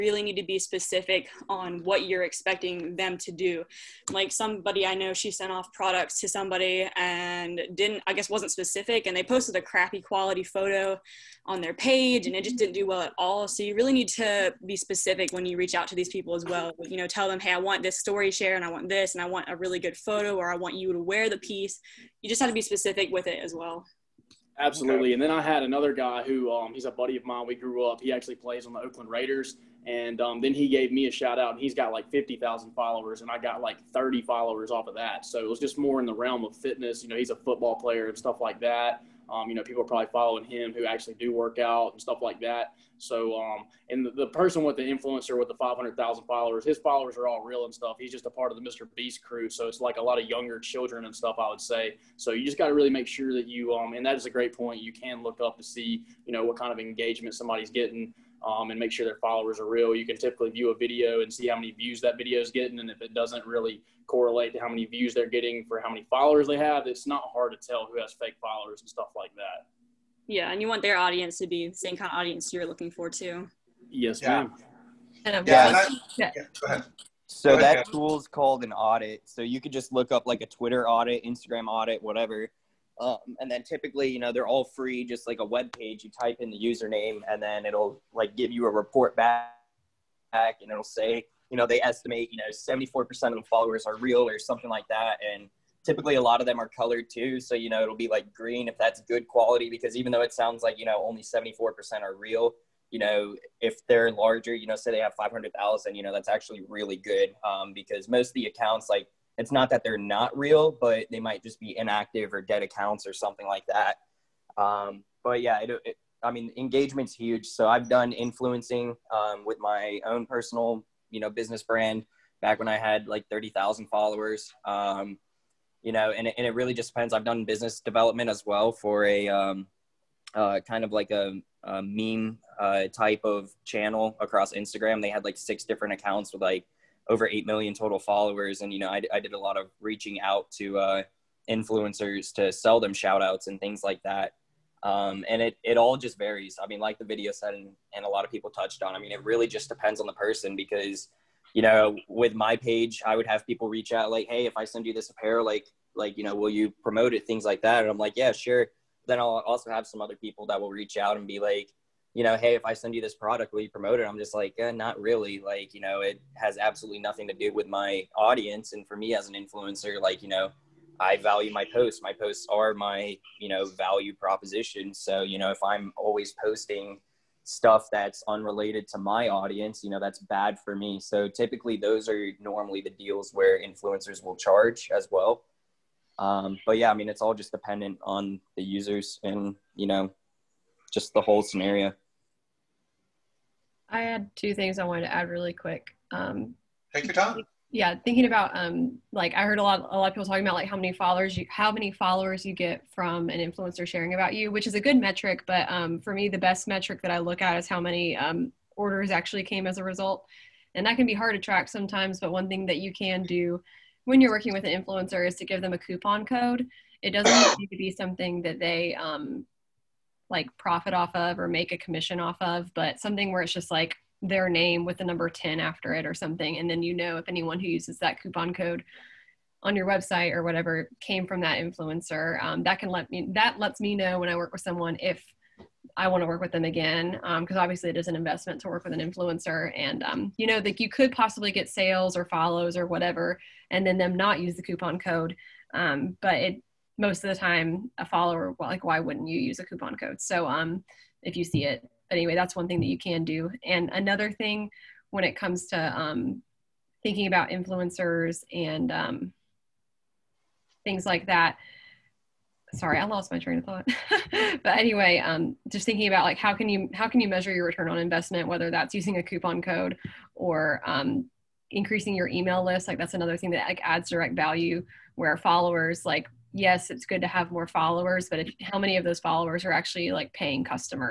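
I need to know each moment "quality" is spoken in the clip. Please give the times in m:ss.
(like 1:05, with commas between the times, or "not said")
0:10, 1:39.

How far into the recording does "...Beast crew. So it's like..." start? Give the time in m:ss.
0:48.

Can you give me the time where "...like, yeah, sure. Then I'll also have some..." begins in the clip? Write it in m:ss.
2:37.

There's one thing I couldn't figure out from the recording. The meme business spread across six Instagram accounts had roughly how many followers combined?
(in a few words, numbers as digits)
8 million.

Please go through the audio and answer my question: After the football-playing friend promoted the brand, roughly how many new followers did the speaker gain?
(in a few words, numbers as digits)
30.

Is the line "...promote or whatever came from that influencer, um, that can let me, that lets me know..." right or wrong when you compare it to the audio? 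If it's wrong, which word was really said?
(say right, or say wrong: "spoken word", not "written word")
wrong: "website", not "promote".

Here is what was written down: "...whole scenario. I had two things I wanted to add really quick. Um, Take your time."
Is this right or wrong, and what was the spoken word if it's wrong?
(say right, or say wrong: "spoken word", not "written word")
right.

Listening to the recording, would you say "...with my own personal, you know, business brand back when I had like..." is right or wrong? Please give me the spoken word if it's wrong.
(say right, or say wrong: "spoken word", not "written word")
right.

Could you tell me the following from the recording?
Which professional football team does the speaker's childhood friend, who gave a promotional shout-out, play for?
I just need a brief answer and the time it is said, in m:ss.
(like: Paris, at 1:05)
Oakland Raiders, at 0:28.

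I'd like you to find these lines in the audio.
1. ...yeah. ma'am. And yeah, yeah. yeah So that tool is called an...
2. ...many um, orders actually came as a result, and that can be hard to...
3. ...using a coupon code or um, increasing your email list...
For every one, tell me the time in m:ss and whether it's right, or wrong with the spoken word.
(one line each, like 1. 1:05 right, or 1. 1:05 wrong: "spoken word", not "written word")
1. 1:14 right
2. 3:27 right
3. 4:28 right.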